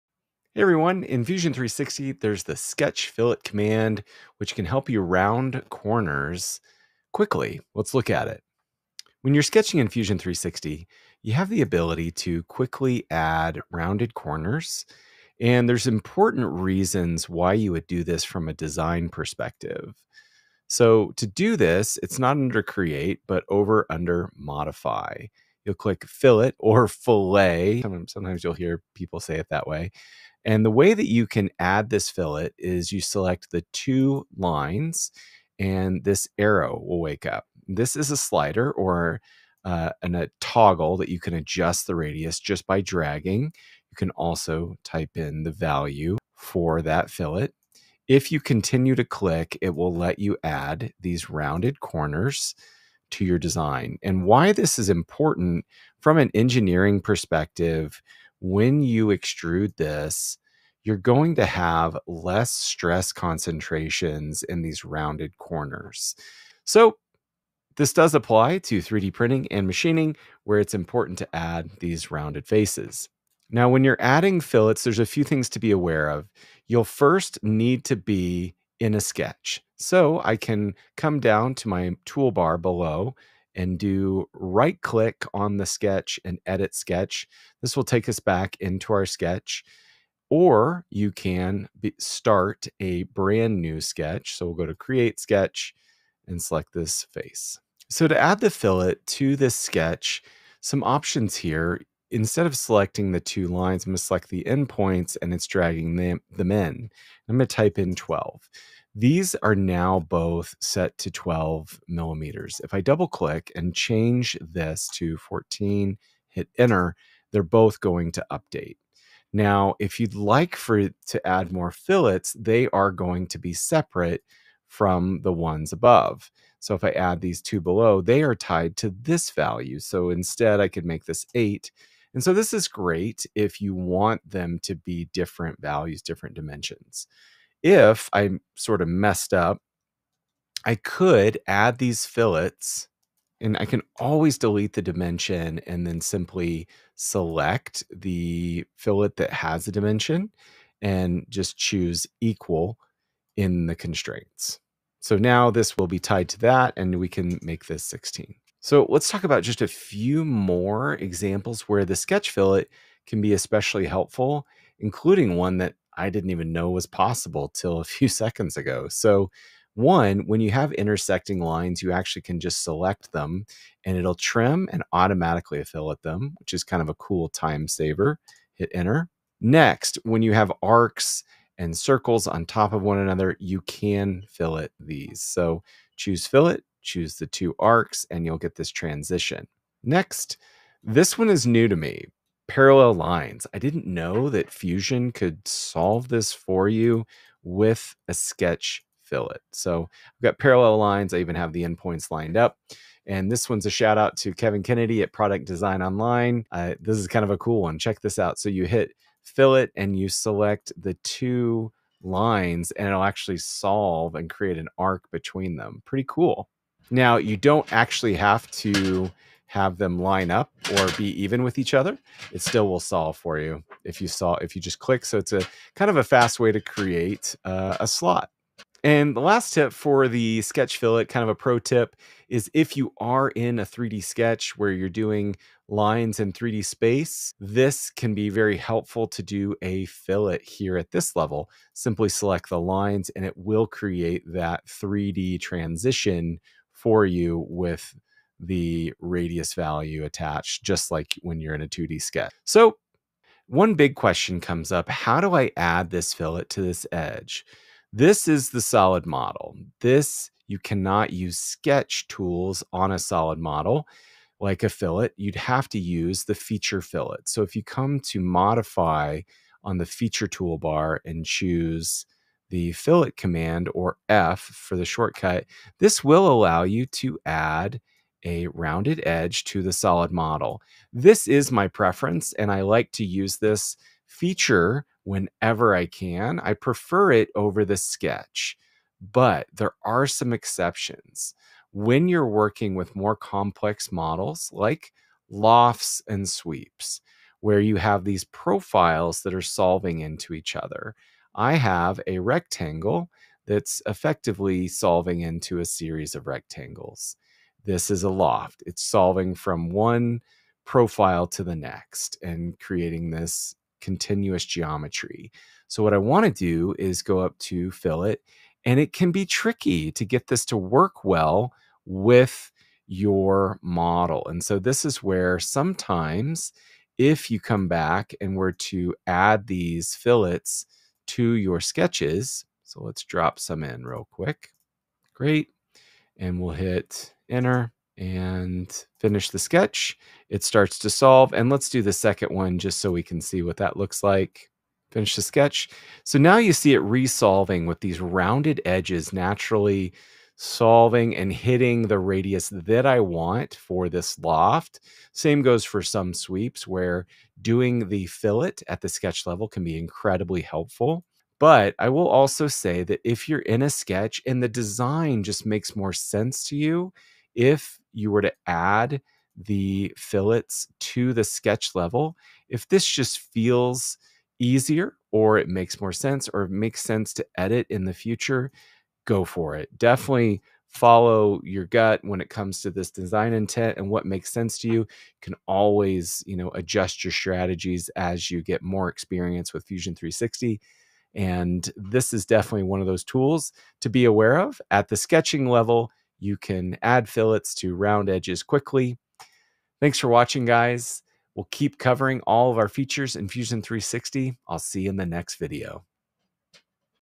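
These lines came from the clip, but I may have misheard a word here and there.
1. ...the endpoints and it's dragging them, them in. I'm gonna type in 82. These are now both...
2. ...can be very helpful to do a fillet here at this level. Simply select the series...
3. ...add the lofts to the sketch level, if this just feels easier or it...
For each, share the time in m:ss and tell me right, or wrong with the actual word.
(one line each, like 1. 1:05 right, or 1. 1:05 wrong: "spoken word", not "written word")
1. 1:44 wrong: "12", not "82"
2. 3:57 wrong: "lines", not "series"
3. 6:08 wrong: "fillets", not "lofts".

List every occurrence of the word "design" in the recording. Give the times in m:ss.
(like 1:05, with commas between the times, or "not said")
0:18, 0:53, 3:25, 6:04, 6:22.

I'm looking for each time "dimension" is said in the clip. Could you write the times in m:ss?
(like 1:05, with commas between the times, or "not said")
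2:16, 2:24, 2:29.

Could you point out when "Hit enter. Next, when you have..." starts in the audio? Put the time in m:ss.
2:58.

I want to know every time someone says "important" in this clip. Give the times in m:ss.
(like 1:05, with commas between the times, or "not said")
0:15, 0:54, 1:10.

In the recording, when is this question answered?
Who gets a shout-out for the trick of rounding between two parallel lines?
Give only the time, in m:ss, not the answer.
3:24.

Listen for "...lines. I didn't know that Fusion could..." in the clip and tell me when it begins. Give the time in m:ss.
3:12.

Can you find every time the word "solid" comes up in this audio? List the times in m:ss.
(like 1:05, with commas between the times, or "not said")
4:18, 4:22, 4:39.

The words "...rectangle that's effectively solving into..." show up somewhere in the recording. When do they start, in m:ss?
5:02.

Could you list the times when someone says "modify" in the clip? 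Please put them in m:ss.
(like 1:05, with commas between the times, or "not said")
0:24, 4:28.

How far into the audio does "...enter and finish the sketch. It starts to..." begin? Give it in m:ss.
5:37.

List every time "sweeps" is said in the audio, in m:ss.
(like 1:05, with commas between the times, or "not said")
4:56, 5:56.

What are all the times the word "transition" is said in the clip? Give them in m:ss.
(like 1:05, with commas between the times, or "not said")
3:08, 4:05.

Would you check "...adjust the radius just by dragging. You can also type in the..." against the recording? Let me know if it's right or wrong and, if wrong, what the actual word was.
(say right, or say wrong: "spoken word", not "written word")
right.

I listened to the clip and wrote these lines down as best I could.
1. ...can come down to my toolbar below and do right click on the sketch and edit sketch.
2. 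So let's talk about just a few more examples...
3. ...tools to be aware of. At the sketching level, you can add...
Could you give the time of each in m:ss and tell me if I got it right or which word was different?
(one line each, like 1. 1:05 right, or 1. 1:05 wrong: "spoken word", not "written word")
1. 1:20 right
2. 2:38 right
3. 6:33 right.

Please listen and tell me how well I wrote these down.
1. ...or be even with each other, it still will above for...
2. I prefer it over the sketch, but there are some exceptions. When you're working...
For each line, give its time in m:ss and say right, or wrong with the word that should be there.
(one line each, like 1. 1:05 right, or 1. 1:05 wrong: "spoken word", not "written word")
1. 3:40 wrong: "solve", not "above"
2. 4:46 right.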